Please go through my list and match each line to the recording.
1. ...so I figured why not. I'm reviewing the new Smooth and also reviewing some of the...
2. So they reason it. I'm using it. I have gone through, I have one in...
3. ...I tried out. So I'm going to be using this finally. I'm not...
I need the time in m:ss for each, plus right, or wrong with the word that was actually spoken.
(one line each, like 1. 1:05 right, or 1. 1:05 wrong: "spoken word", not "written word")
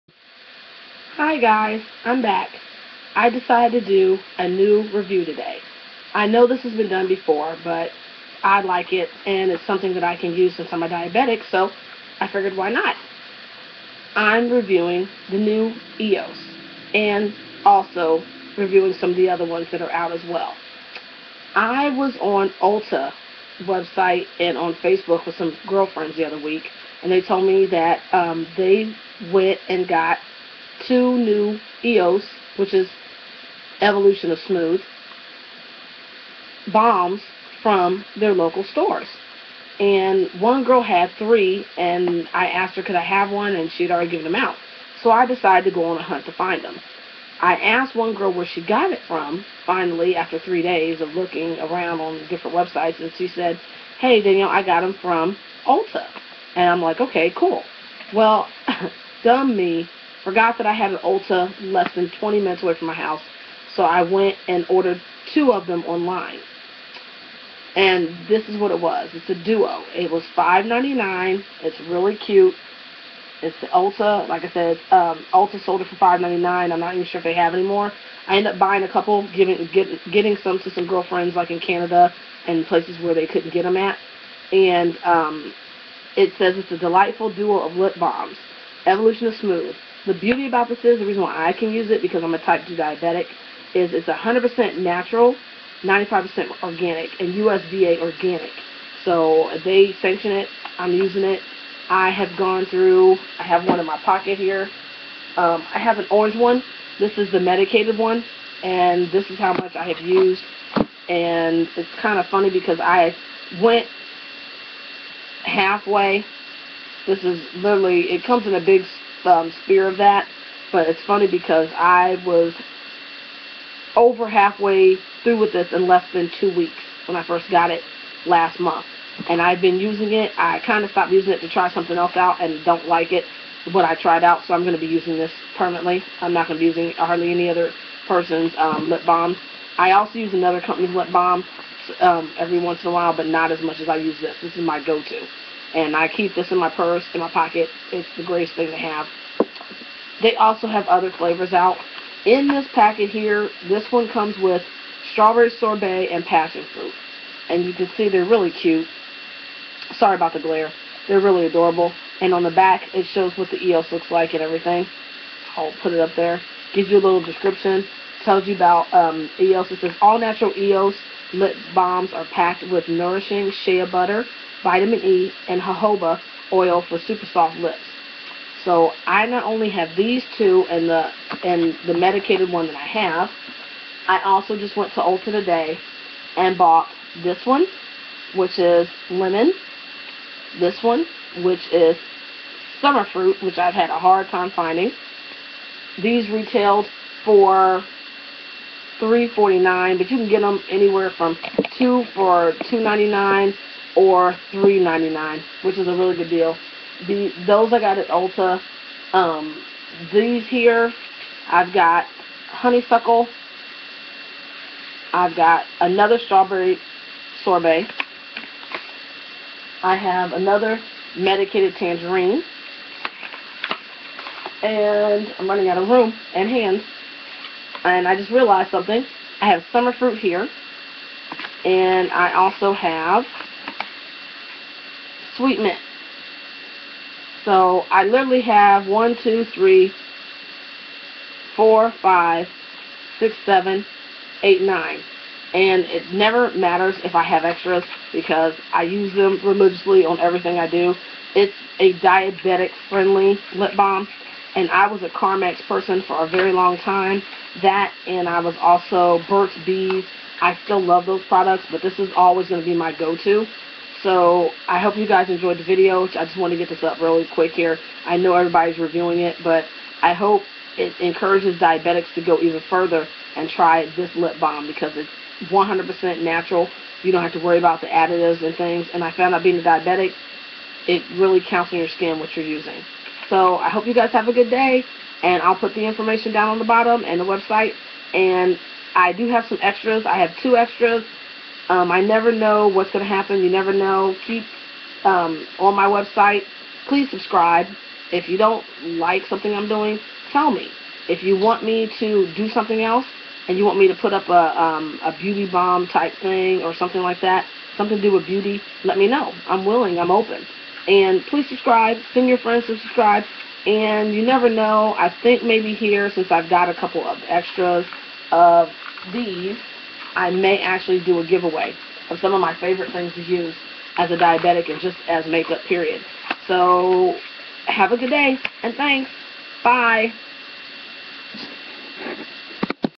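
1. 0:11 wrong: "EOS", not "Smooth"
2. 1:39 wrong: "sanction", not "reason"
3. 2:13 wrong: "permanently", not "finally".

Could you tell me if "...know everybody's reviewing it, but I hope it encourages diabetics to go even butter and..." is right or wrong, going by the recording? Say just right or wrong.
wrong.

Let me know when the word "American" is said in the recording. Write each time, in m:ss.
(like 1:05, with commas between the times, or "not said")
not said.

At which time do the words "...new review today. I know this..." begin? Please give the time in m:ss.
0:04.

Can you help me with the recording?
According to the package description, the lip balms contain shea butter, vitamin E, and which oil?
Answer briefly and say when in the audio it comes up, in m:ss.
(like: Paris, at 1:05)
jojoba oil, at 2:55.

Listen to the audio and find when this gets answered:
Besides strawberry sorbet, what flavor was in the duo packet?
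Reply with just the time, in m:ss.
2:36.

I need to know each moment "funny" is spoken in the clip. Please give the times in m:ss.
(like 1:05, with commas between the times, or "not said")
1:52, 2:01.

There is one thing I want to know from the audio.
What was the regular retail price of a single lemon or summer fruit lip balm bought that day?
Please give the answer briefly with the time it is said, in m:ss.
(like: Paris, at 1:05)
$3.49, at 3:19.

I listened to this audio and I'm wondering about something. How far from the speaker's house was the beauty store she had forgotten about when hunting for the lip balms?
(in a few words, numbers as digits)
less than 20 minutes.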